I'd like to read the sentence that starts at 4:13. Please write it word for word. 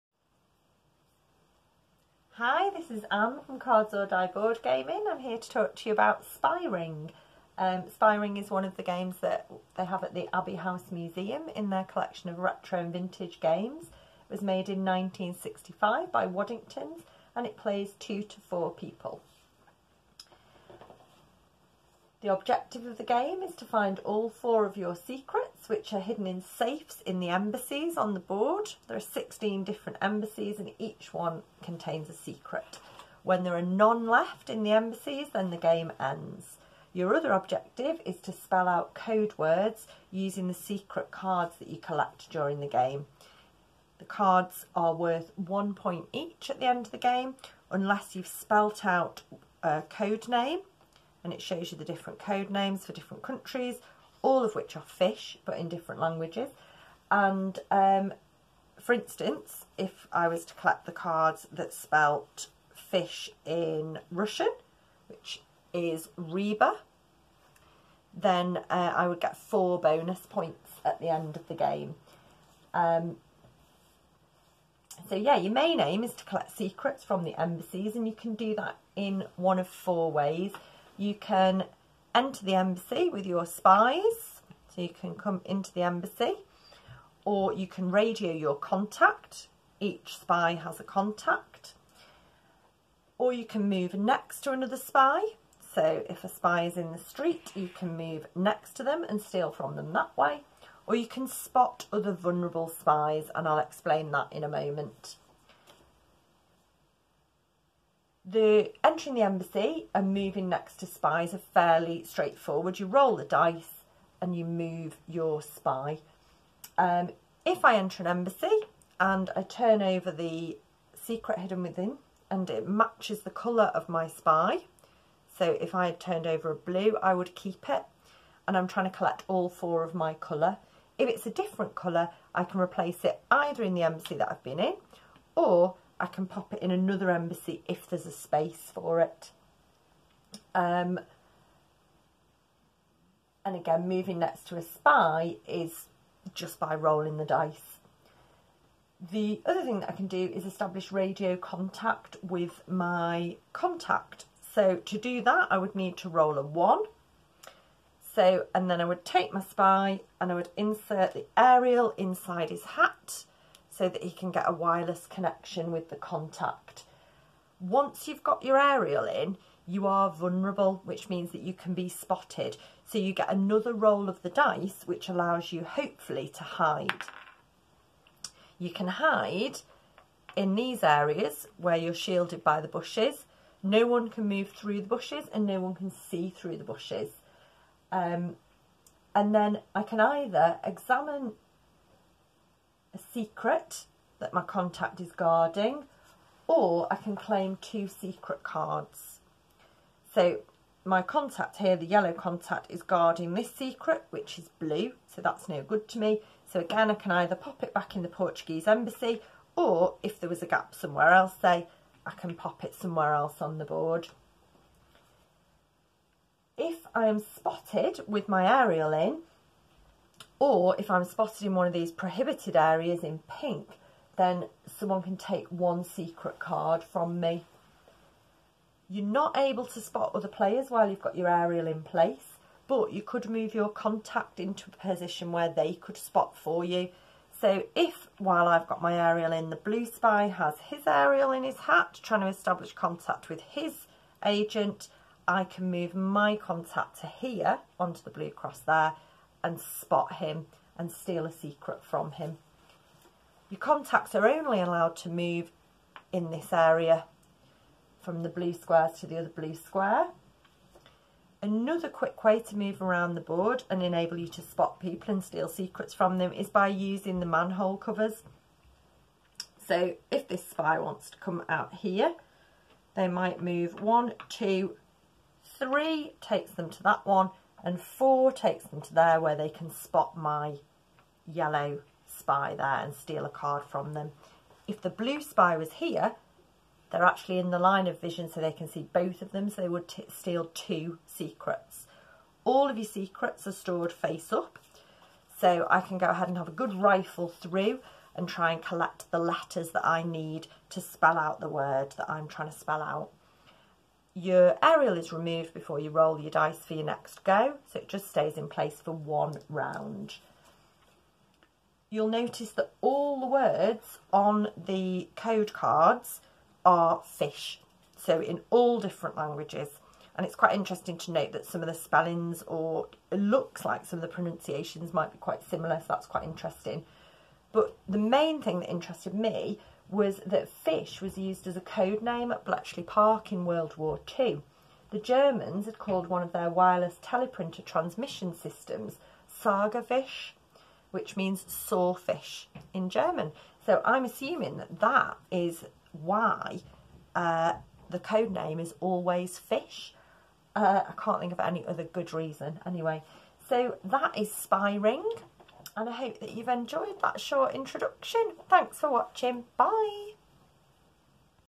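Your contacts are only allowed to move in this area from the blue squares to the other blue square.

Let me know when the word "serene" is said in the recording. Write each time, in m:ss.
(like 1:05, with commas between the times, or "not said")
not said.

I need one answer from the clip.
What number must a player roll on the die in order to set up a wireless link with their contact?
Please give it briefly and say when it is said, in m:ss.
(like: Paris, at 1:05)
1, at 2:36.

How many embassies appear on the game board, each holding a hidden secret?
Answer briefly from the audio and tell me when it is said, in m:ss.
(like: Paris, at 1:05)
16, at 0:28.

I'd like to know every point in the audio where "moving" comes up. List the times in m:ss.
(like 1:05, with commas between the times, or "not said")
1:50, 2:23.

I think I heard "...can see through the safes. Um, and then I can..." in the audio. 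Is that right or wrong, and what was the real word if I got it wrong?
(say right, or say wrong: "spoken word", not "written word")
wrong: "bushes", not "safes".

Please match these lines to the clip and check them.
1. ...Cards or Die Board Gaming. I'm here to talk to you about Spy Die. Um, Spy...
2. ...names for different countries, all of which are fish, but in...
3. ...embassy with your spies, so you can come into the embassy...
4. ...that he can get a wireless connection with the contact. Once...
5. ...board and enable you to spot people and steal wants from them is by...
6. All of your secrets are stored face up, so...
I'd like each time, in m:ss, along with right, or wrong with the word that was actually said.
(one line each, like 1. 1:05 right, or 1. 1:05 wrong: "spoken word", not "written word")
1. 0:03 wrong: "Ring", not "Die"
2. 0:52 right
3. 1:22 right
4. 2:43 right
5. 4:23 wrong: "secrets", not "wants"
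6. 4:52 right.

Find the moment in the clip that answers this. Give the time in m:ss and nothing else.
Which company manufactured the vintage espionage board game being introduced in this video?
0:16.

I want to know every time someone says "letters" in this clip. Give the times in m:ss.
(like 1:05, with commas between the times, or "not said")
4:59.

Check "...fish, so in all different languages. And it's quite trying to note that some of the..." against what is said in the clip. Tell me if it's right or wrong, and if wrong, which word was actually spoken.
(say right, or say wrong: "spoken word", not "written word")
wrong: "interesting", not "trying".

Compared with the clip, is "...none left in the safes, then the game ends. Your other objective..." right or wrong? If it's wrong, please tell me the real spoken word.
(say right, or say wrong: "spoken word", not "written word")
wrong: "embassies", not "safes".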